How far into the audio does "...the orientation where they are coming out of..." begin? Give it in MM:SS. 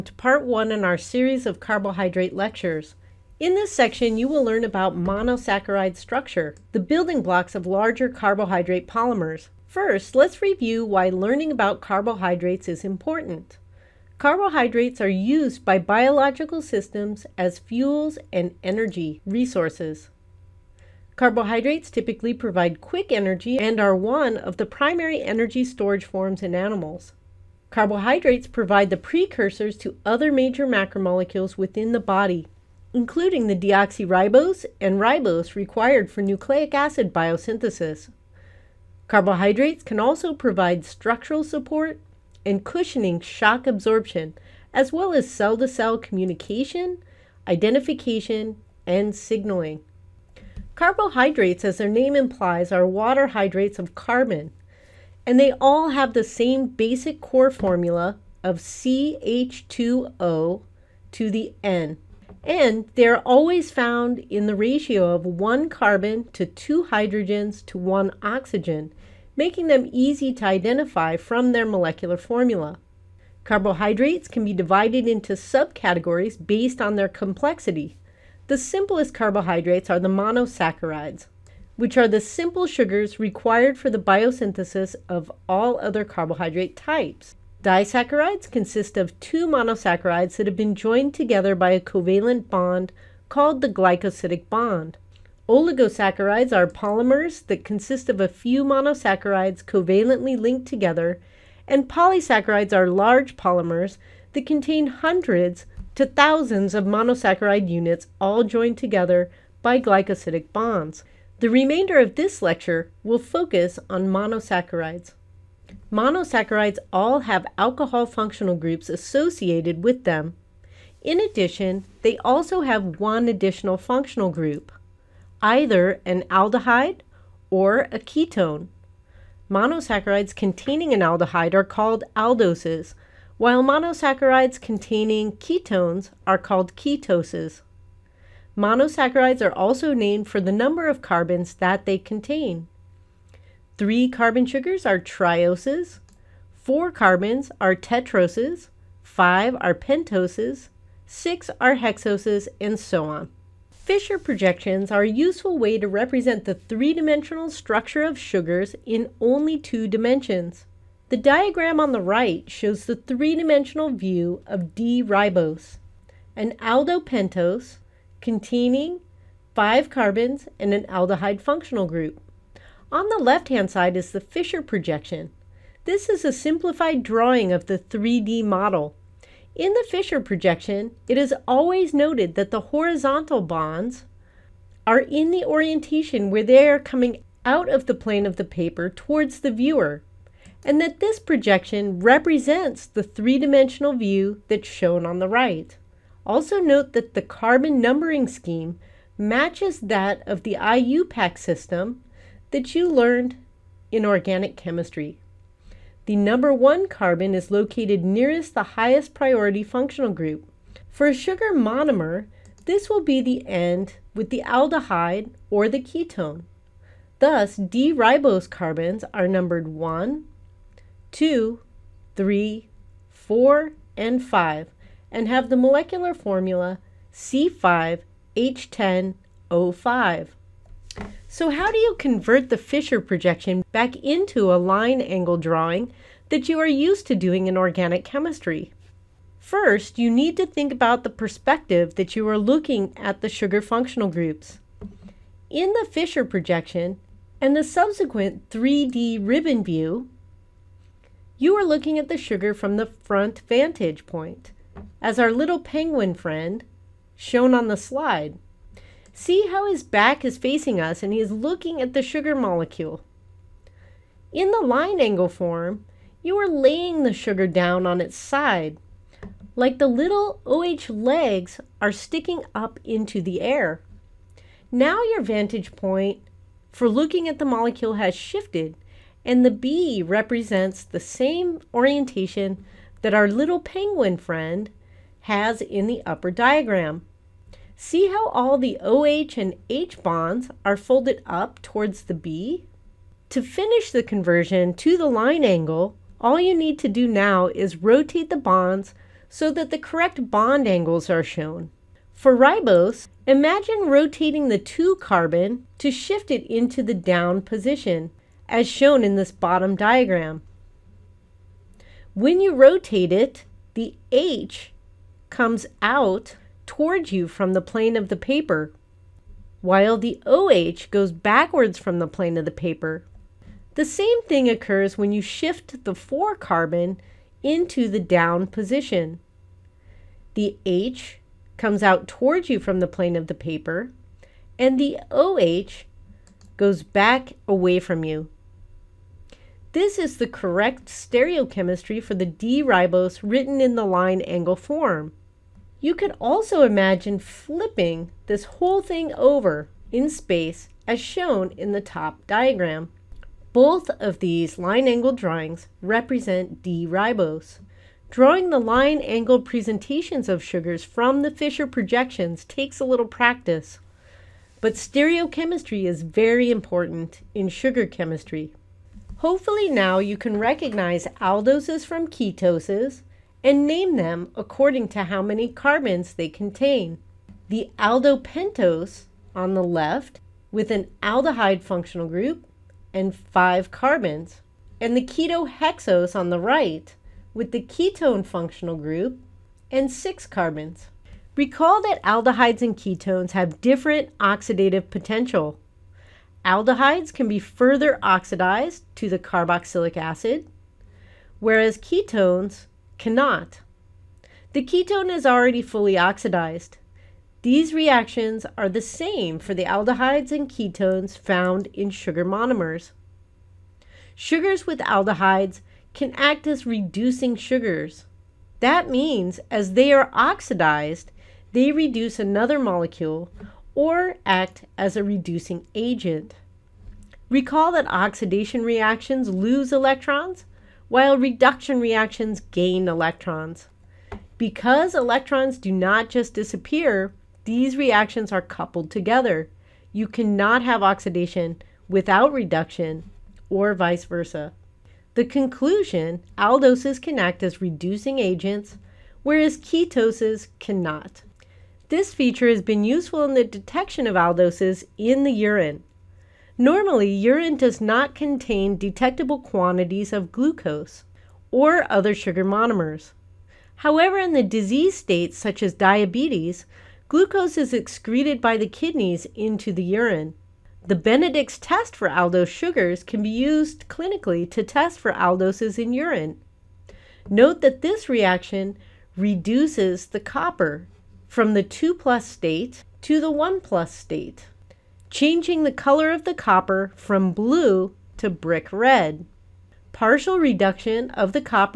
03:05.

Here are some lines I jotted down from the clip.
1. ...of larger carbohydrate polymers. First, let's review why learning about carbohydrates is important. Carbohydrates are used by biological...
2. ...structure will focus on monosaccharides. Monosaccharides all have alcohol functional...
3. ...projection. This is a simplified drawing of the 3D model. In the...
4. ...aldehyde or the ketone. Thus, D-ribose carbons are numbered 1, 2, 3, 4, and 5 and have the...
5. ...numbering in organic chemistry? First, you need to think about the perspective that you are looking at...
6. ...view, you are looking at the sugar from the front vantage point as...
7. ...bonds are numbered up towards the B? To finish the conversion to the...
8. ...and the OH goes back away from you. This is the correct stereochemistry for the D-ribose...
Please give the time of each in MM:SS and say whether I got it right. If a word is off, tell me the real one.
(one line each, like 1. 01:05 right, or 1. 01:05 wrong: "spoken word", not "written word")
1. 00:07 right
2. 01:52 wrong: "lecture", not "structure"
3. 02:54 right
4. 03:34 right
5. 03:57 wrong: "doing", not "numbering"
6. 04:09 right
7. 04:50 wrong: "folded", not "numbered"
8. 05:34 right.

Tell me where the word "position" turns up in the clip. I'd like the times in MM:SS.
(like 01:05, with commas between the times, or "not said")
05:07, 05:28.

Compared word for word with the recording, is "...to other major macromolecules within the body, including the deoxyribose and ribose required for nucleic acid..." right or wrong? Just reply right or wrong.
right.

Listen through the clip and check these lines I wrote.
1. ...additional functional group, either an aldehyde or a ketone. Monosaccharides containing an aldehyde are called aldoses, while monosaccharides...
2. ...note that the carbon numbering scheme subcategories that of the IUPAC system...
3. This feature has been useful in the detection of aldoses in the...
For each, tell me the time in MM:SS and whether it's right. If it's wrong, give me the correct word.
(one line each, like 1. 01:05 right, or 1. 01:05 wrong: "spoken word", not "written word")
1. 02:03 right
2. 03:16 wrong: "matches", not "subcategories"
3. 07:31 right.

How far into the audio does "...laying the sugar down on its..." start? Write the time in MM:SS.
04:26.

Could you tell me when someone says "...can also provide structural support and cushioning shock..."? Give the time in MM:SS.
00:39.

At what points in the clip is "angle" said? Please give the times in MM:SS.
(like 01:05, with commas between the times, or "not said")
03:54, 04:24, 04:55, 05:00, 05:44, 05:54, 05:59.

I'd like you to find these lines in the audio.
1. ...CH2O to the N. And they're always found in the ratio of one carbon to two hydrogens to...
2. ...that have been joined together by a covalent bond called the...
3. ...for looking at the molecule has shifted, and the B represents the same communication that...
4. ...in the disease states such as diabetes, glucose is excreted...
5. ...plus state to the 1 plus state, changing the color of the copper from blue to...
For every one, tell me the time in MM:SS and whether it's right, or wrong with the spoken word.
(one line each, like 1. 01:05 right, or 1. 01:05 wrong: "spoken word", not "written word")
1. 00:58 right
2. 01:30 right
3. 04:36 wrong: "orientation", not "communication"
4. 07:44 right
5. 08:01 right.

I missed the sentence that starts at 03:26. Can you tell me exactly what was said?
The number one carbon is located nearest the highest priority functional group.